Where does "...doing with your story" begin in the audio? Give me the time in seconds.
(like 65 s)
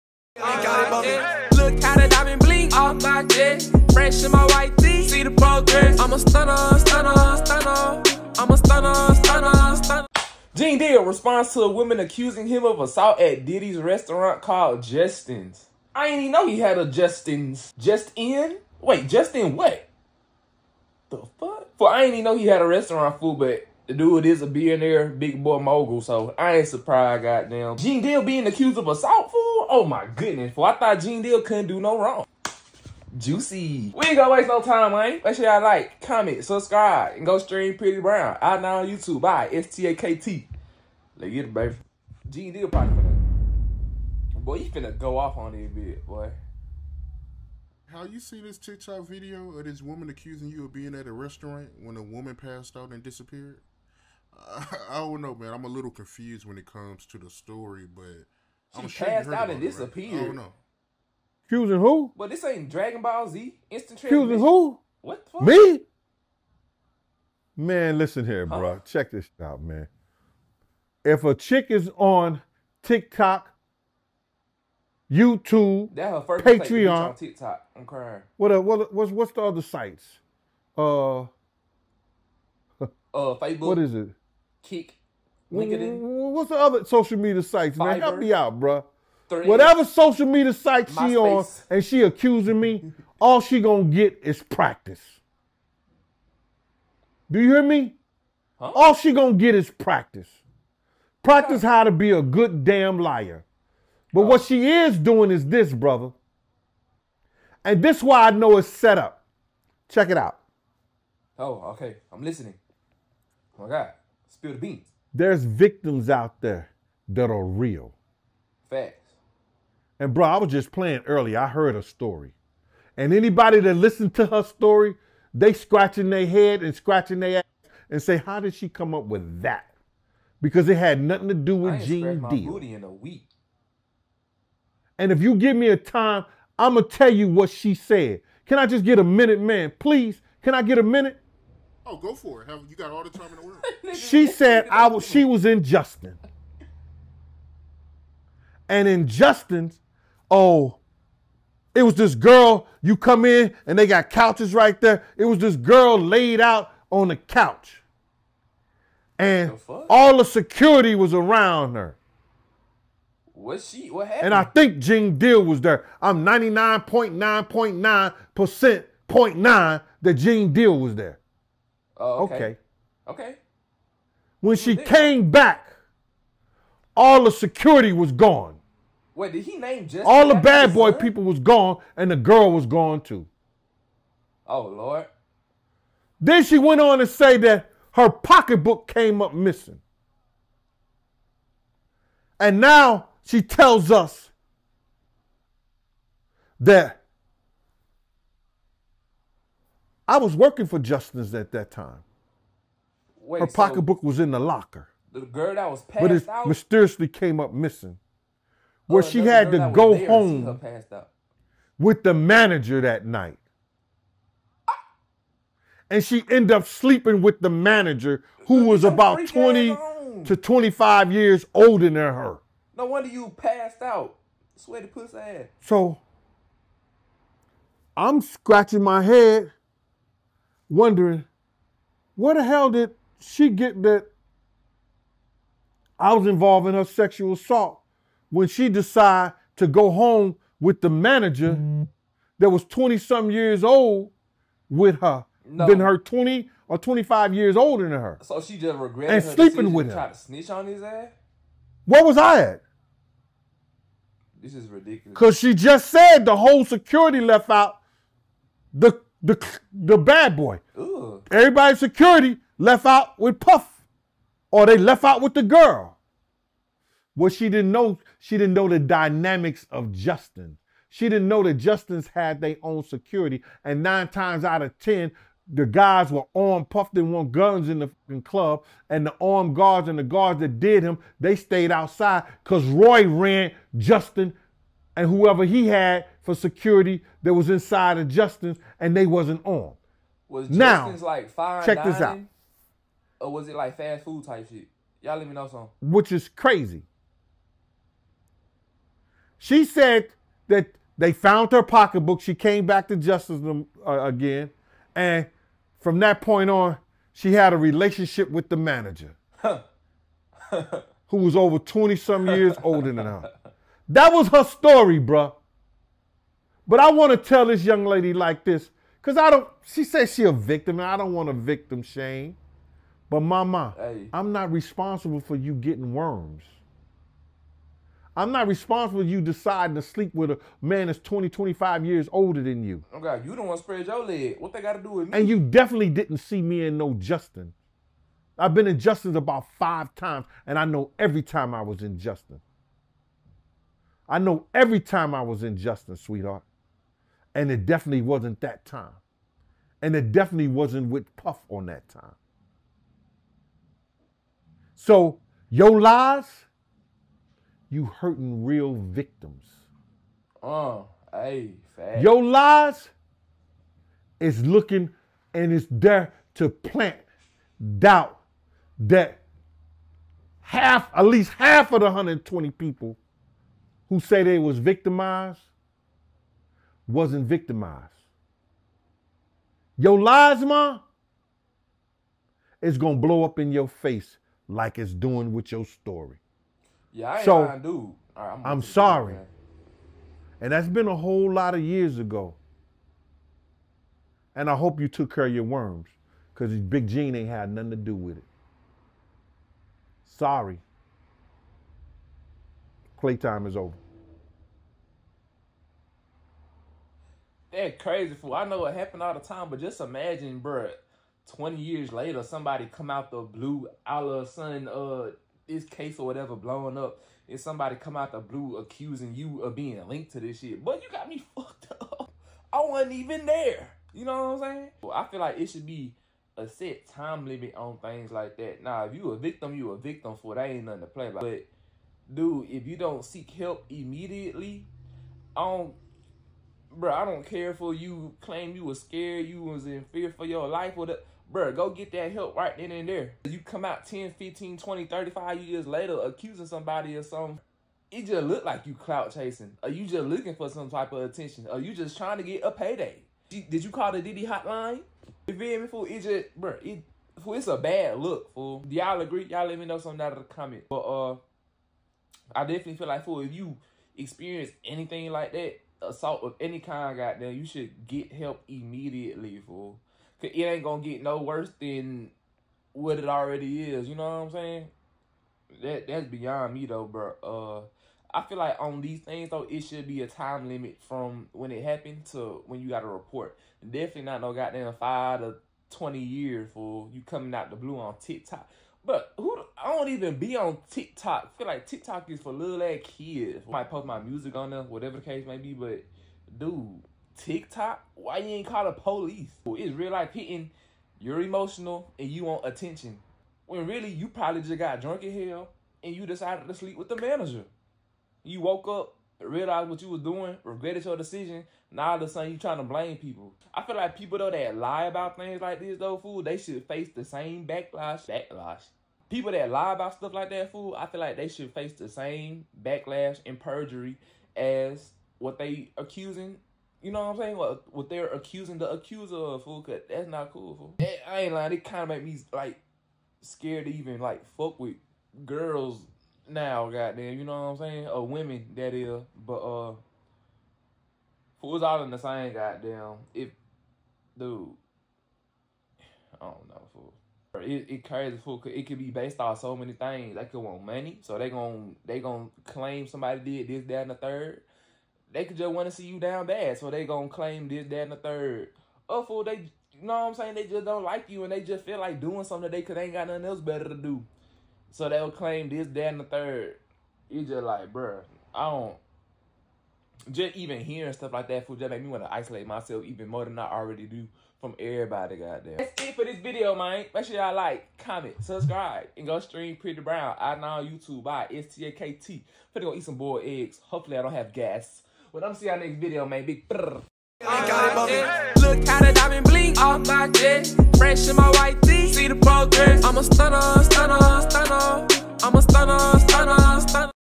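384 s.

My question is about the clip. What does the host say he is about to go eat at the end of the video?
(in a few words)
boiled eggs.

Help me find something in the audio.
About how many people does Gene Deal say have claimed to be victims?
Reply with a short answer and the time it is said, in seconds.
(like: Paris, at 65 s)
120, at 371 s.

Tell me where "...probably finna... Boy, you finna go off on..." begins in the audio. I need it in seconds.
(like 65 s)
42 s.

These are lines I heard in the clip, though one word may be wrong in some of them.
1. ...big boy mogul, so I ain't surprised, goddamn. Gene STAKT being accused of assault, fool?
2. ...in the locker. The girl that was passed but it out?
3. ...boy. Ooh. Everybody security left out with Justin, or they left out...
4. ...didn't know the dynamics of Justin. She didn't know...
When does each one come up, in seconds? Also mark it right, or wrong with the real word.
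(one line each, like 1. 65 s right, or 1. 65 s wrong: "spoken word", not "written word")
1. 25 s wrong: "Deal", not "STAKT"
2. 204 s right
3. 260 s wrong: "Puff", not "Justin"
4. 268 s right.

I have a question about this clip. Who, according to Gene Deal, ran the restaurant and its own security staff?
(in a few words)
Roy.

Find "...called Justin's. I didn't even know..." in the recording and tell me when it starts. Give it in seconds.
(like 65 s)
14 s.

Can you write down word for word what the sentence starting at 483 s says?
Definitely not no goddamn five to twenty years for you coming out the blue on TikTok.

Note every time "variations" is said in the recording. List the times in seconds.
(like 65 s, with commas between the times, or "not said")
not said.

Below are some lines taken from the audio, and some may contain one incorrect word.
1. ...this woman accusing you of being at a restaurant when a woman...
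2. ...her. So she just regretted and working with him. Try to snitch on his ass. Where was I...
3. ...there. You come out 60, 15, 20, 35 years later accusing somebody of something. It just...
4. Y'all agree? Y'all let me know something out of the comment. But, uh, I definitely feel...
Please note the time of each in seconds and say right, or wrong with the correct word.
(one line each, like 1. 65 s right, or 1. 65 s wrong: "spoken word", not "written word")
1. 49 s right
2. 247 s wrong: "sleeping", not "working"
3. 442 s wrong: "10", not "60"
4. 458 s right.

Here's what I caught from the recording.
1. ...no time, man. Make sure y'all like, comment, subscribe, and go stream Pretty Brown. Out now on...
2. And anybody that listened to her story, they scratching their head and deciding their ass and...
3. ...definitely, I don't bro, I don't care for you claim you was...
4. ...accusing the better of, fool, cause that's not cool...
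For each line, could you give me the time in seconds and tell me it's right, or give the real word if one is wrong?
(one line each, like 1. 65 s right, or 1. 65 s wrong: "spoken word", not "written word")
1. 34 s right
2. 122 s wrong: "scratching", not "deciding"
3. 433 s wrong: "immediately", not "definitely"
4. 528 s wrong: "accuser", not "better".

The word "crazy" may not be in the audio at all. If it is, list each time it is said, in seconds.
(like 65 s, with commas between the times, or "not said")
296 s, 407 s, 547 s.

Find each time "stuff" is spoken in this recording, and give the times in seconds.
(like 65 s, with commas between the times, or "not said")
519 s, 570 s.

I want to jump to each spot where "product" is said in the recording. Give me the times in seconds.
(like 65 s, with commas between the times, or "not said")
not said.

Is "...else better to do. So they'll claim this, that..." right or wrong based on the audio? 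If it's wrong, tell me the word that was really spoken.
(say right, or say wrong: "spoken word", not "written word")
right.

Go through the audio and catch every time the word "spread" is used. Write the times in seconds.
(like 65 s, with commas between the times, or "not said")
333 s.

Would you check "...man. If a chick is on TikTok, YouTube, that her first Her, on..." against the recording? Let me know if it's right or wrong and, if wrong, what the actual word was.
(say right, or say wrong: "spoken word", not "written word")
wrong: "Patreon", not "Her".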